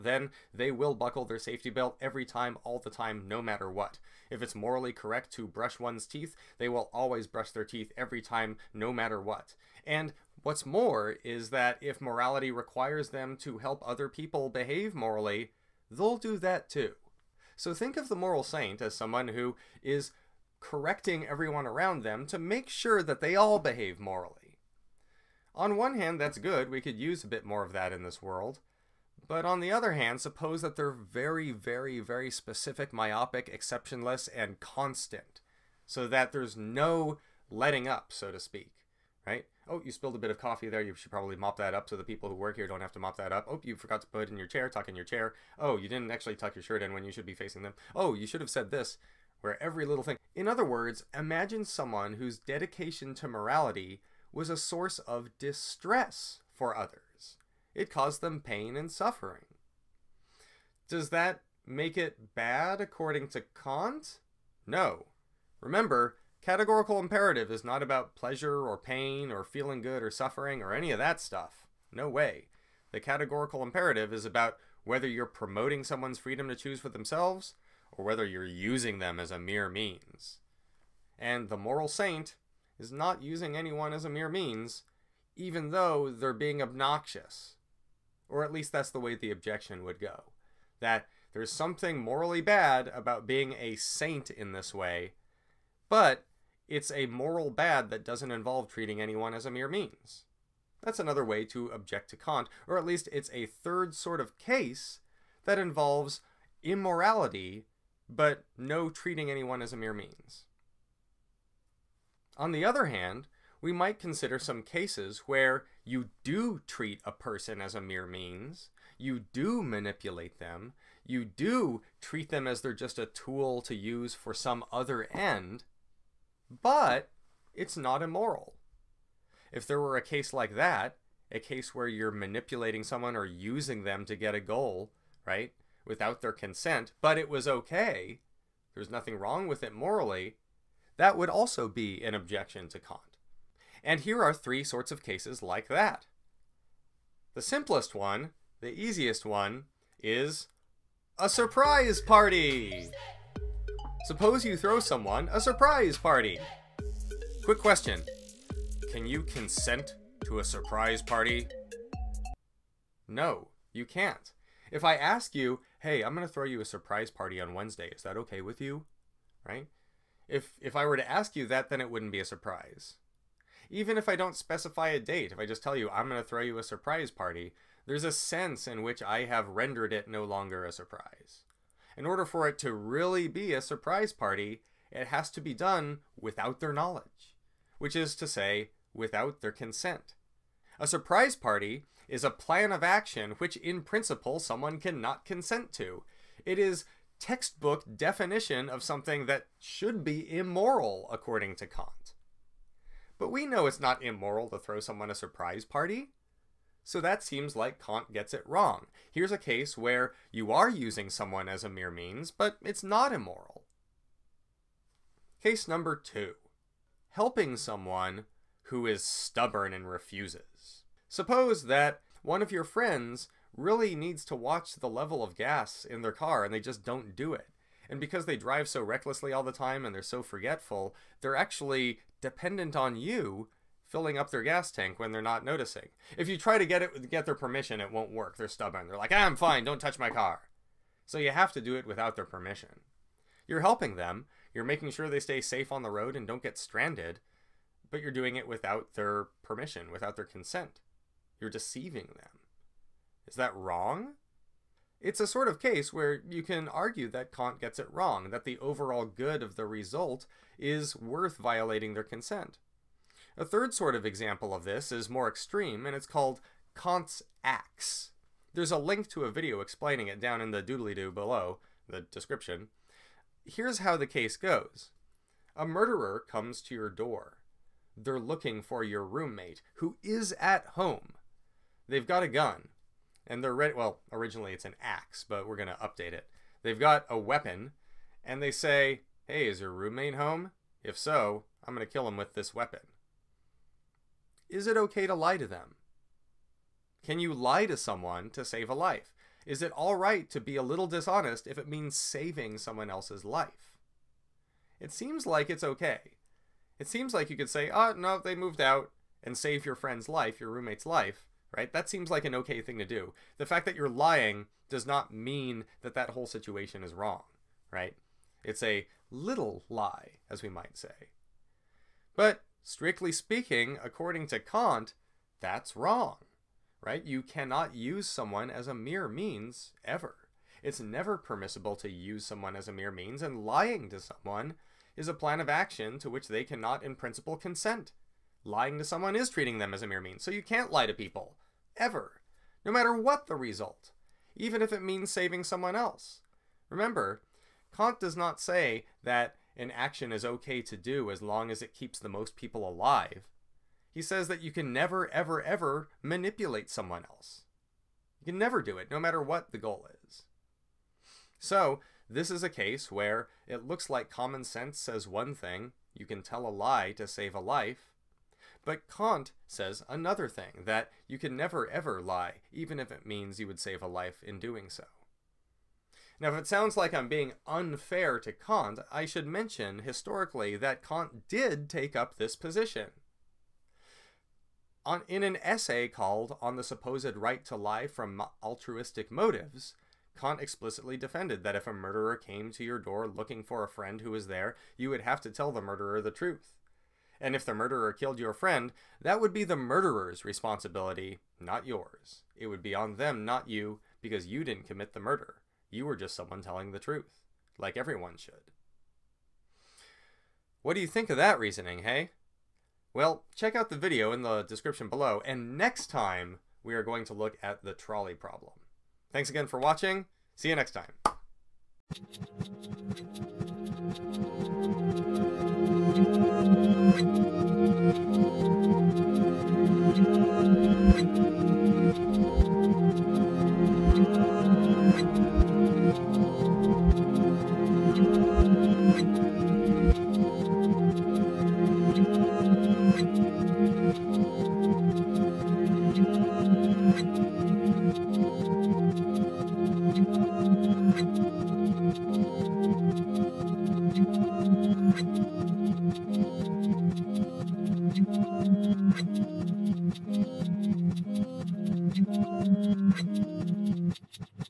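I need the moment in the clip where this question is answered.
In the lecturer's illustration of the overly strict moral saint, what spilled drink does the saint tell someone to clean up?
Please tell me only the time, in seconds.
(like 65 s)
40 s.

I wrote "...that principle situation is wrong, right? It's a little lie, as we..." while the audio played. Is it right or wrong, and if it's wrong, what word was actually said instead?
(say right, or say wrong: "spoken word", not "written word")
wrong: "whole", not "principle".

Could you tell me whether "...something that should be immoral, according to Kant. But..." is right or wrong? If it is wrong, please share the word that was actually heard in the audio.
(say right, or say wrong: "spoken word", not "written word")
right.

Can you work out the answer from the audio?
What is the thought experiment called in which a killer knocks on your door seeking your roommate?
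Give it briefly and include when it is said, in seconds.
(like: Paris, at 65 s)
Kant's axe, at 266 s.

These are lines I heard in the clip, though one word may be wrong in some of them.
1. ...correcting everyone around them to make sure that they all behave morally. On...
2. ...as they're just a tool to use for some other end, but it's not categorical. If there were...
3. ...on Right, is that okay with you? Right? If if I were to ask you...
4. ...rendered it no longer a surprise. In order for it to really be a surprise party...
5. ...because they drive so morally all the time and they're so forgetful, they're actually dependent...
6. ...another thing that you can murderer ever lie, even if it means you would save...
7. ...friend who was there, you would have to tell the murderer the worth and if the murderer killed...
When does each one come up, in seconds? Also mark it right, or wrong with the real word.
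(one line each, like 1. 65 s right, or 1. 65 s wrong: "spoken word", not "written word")
1. 20 s right
2. 122 s wrong: "immoral", not "categorical"
3. 167 s wrong: "Wednesday", not "Right"
4. 179 s right
5. 227 s wrong: "recklessly", not "morally"
6. 369 s wrong: "never", not "murderer"
7. 393 s wrong: "truth", not "worth".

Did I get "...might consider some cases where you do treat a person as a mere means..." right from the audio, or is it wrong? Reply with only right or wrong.
right.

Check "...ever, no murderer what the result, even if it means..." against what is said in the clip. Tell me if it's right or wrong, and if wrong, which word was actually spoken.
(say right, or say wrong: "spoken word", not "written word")
wrong: "matter", not "murderer".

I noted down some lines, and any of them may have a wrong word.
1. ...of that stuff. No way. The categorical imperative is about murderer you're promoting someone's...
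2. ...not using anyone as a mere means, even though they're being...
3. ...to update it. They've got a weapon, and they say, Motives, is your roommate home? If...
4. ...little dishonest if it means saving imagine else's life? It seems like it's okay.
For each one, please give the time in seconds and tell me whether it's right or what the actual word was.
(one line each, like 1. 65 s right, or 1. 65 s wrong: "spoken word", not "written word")
1. 70 s wrong: "whether", not "murderer"
2. 82 s right
3. 285 s wrong: "Hey", not "Motives"
4. 300 s wrong: "someone", not "imagine".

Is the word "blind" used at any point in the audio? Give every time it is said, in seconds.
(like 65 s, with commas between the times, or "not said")
not said.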